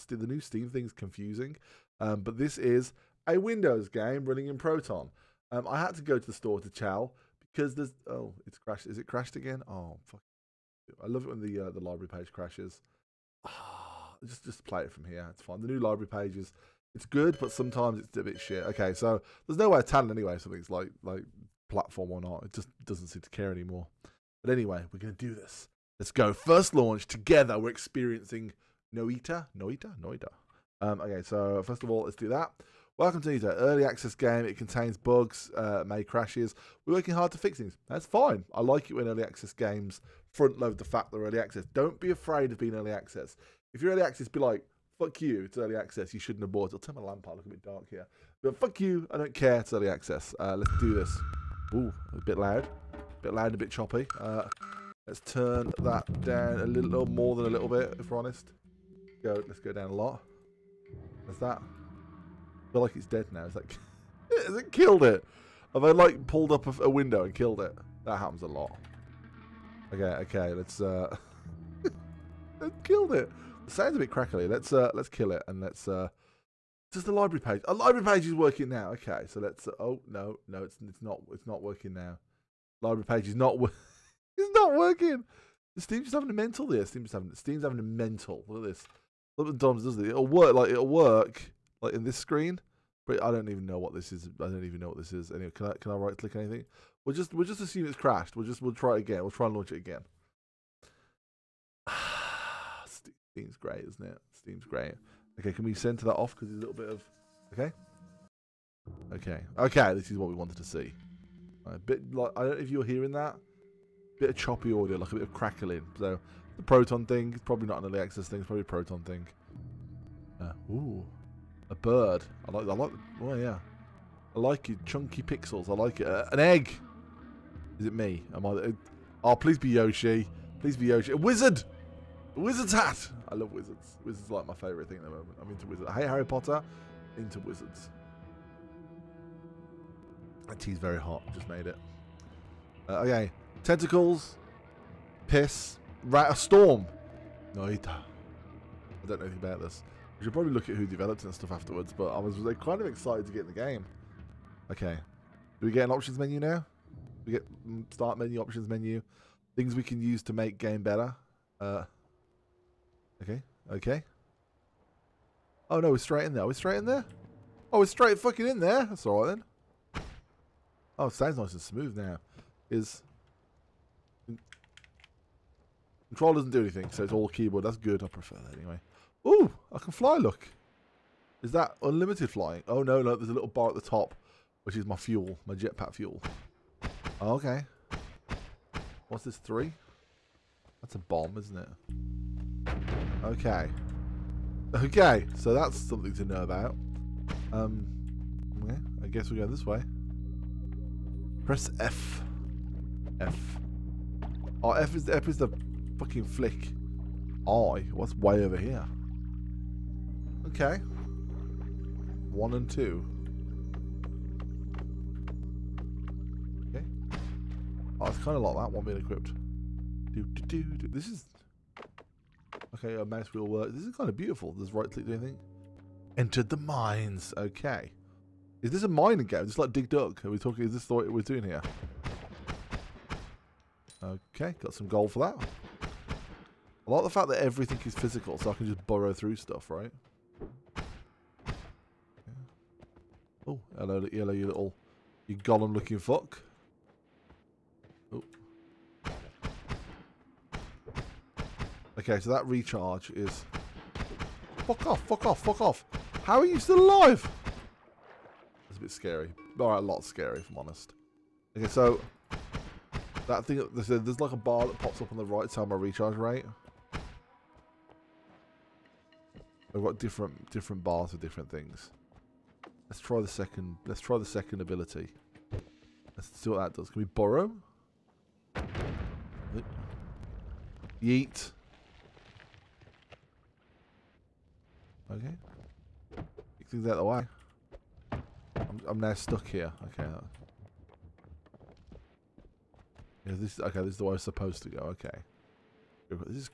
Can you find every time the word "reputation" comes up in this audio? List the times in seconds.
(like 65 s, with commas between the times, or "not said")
not said.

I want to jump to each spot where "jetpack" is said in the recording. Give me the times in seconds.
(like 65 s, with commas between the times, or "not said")
185 s.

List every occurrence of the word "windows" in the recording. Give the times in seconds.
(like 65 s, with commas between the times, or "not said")
3 s, 66 s.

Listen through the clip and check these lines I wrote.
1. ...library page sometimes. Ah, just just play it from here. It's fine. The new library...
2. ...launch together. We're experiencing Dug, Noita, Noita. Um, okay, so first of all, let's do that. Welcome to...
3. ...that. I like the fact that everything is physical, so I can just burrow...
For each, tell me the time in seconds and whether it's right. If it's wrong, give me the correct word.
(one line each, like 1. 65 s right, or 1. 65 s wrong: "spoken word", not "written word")
1. 11 s wrong: "crashes", not "sometimes"
2. 26 s wrong: "Noita", not "Dug"
3. 235 s right.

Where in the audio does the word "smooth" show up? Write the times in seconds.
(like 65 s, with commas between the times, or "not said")
171 s.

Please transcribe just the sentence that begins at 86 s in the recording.
Steam's having Steam's having a mental.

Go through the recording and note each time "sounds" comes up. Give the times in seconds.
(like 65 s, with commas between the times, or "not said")
73 s, 171 s.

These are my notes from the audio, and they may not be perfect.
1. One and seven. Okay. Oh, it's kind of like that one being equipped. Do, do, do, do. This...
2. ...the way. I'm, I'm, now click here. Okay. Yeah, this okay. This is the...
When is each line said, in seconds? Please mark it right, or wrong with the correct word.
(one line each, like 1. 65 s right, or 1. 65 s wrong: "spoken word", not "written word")
1. 212 s wrong: "two", not "seven"
2. 286 s wrong: "stuck", not "click".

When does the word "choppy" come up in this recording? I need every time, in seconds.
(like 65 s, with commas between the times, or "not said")
53 s, 114 s.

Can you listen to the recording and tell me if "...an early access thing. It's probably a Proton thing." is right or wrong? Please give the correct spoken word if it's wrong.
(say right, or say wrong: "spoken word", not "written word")
right.